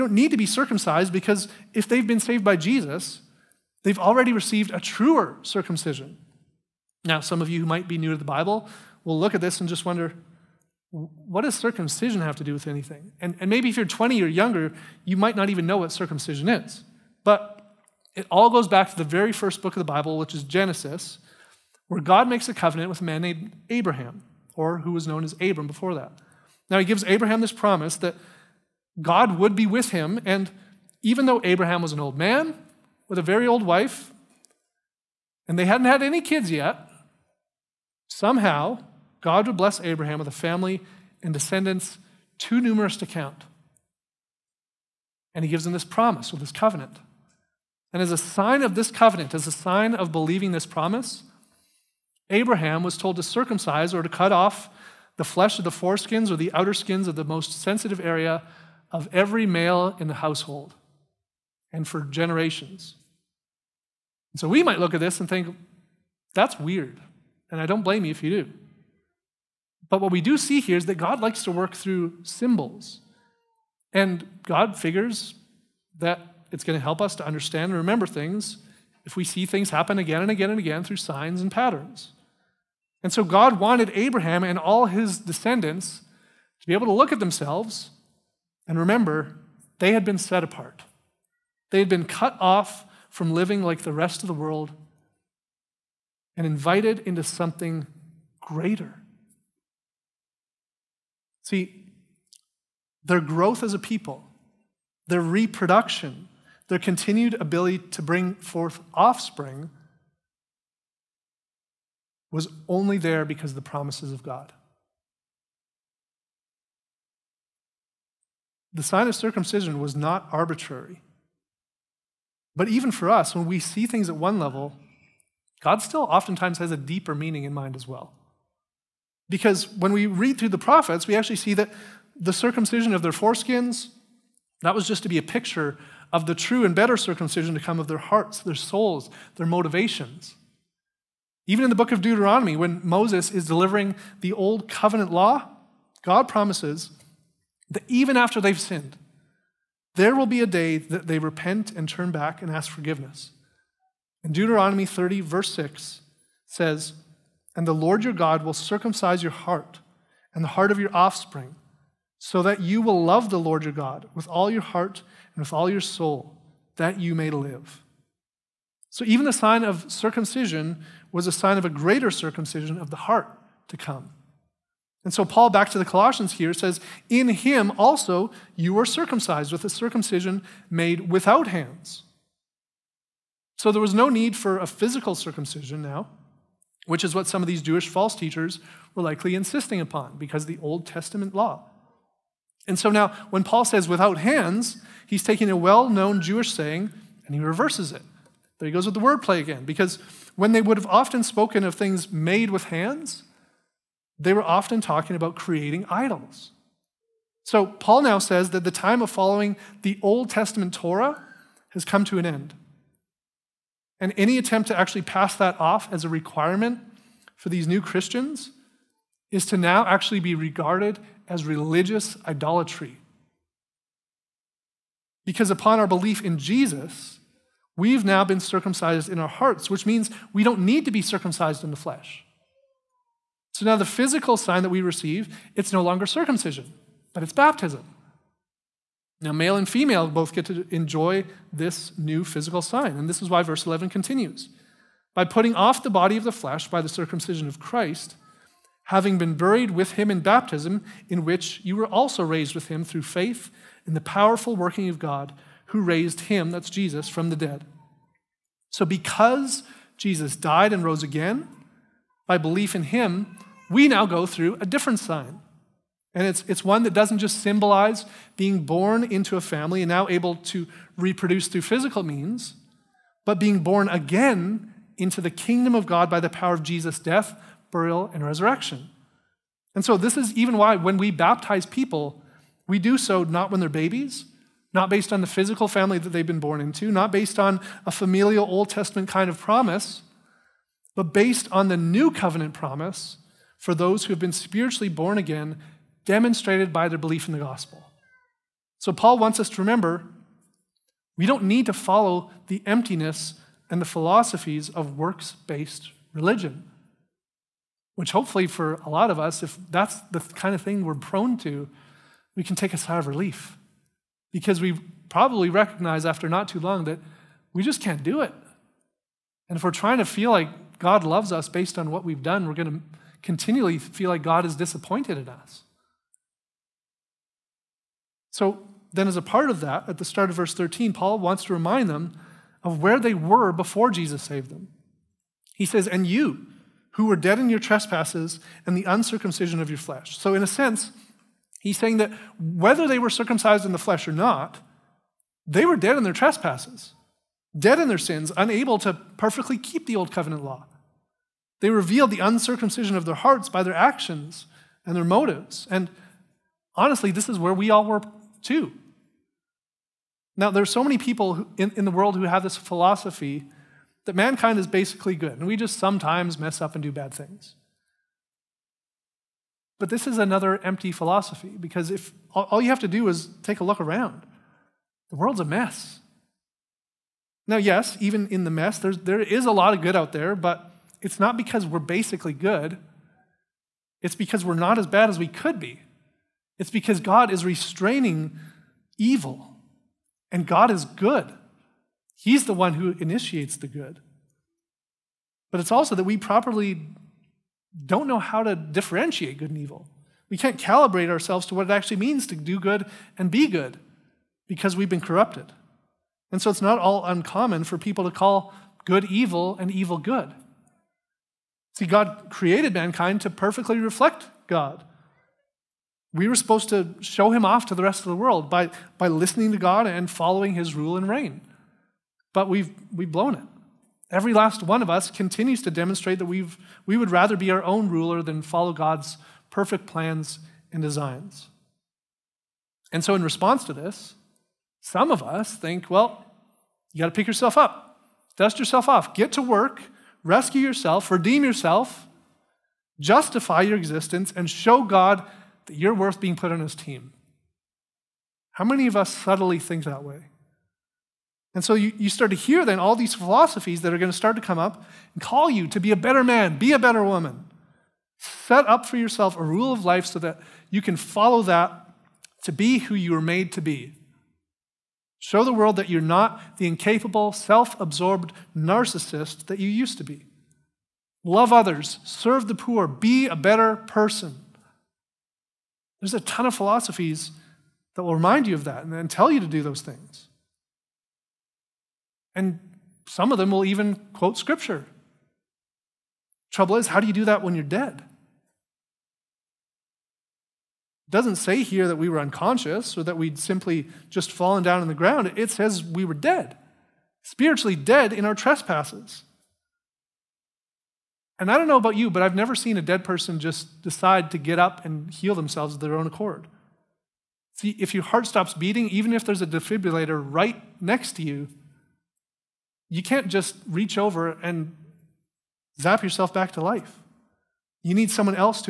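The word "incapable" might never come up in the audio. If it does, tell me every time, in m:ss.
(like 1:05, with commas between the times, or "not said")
7:46.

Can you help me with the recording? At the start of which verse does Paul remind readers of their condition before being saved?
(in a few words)
verse 13.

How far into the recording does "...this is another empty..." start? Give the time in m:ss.
6:09.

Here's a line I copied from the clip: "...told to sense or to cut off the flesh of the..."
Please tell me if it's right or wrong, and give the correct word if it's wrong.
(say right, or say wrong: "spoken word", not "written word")
wrong: "circumcise", not "sense".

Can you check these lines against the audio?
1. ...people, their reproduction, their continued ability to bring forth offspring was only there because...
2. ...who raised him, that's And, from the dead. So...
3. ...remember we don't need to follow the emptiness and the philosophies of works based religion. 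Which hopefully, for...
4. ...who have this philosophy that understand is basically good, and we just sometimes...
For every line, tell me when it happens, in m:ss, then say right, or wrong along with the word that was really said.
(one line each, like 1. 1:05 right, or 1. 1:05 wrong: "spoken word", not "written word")
1. 1:43 right
2. 4:15 wrong: "Jesus", not "And"
3. 4:59 right
4. 6:02 wrong: "mankind", not "understand".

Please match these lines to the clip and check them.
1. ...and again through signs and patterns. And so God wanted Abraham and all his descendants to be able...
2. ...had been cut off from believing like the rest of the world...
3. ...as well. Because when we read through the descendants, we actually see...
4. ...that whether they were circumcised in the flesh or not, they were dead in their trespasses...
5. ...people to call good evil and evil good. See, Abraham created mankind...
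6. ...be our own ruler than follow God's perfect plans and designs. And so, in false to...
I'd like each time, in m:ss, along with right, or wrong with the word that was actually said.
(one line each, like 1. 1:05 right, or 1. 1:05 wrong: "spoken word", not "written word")
1. 1:20 right
2. 1:31 wrong: "living", not "believing"
3. 2:07 wrong: "prophets", not "descendants"
4. 5:41 right
5. 6:47 wrong: "God", not "Abraham"
6. 7:07 wrong: "response", not "false".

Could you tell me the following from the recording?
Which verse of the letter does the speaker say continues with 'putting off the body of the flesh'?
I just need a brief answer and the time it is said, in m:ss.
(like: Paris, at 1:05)
verse 11, at 4:03.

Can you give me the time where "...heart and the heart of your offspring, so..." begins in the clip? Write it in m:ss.
2:39.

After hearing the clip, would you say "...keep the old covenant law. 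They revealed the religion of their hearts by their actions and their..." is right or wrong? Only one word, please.
wrong.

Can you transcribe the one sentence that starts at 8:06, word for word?
Trouble is, how do you do that when you're dead?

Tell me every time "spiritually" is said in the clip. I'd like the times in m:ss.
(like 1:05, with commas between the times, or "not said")
4:54, 8:17.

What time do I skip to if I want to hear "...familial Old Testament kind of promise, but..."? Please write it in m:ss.
4:47.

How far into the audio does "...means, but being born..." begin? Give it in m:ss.
4:32.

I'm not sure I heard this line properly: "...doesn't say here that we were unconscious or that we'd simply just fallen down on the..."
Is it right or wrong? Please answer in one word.
right.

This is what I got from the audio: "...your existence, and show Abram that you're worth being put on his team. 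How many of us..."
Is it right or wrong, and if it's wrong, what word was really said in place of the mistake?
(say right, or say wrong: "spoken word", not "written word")
wrong: "God", not "Abram".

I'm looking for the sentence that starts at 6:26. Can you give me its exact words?
It's because God is restraining evil, and God is good.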